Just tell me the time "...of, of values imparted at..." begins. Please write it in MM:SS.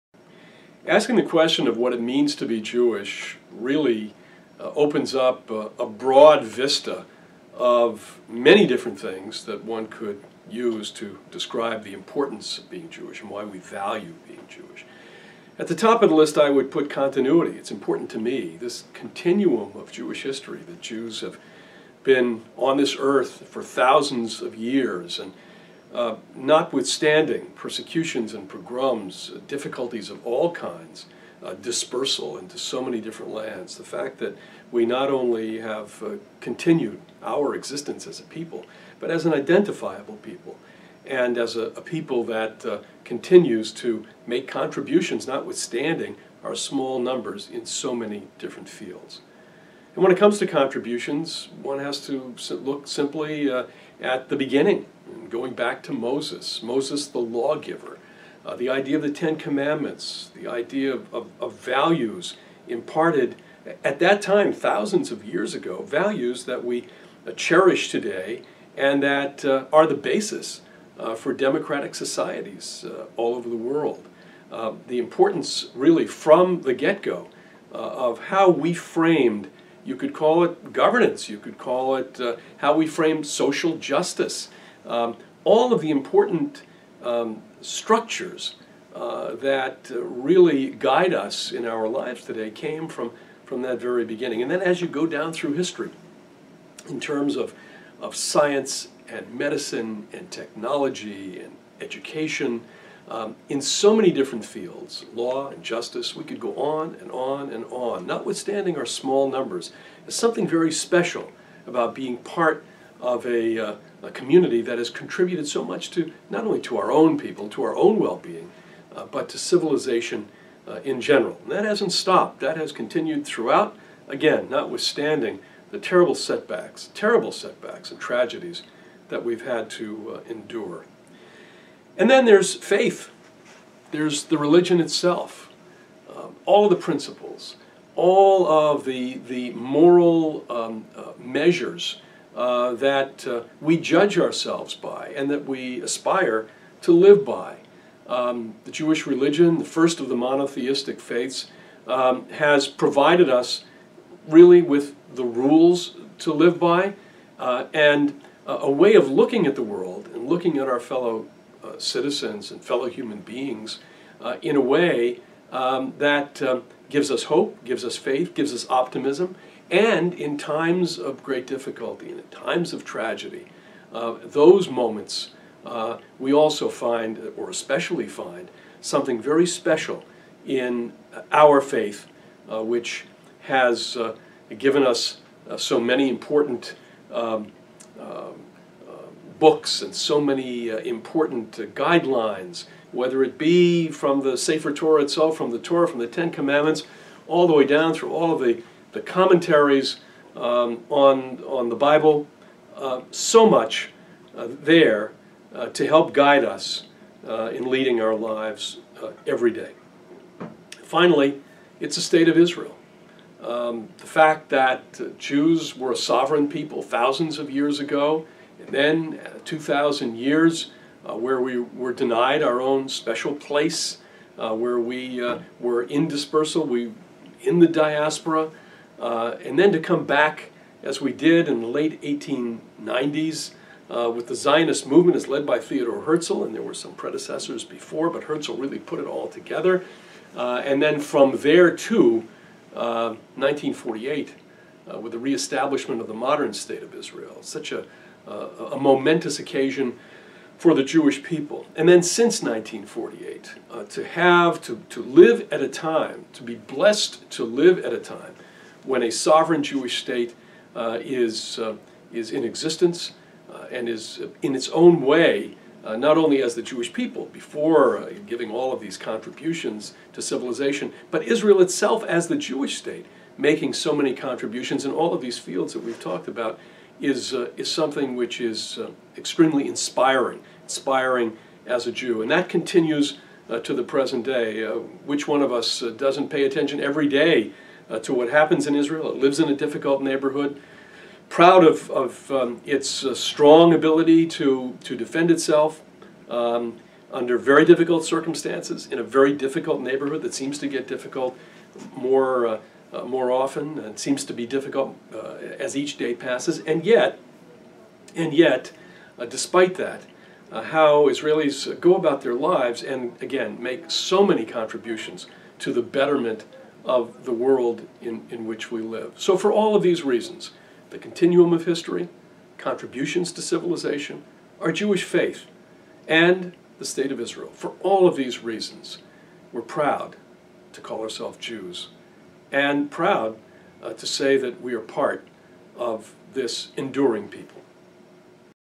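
01:01.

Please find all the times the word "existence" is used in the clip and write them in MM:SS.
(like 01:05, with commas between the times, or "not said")
00:37, 04:22.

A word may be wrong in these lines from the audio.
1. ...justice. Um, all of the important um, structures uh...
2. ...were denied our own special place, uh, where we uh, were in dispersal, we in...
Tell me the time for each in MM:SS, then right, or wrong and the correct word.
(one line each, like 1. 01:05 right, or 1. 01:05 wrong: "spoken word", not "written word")
1. 01:23 right
2. 03:41 right.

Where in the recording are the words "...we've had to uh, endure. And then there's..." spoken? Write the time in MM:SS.
02:09.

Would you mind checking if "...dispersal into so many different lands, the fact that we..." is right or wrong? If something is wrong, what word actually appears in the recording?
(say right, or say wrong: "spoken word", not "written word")
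right.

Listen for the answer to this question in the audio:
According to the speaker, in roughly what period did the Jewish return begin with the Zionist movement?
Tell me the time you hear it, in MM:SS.
03:51.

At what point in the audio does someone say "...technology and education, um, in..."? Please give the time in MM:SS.
01:40.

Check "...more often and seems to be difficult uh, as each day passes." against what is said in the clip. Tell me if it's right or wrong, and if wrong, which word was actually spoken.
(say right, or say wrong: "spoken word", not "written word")
right.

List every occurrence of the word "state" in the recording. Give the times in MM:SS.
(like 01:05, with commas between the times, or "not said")
03:32, 04:06, 04:20, 04:32, 05:26.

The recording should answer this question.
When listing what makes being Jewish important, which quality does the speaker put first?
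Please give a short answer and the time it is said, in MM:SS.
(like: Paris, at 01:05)
Continuity, at 00:16.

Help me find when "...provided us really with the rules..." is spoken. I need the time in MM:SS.
02:32.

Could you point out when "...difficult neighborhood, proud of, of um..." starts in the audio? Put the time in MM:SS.
04:49.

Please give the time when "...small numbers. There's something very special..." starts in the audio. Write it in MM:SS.
01:48.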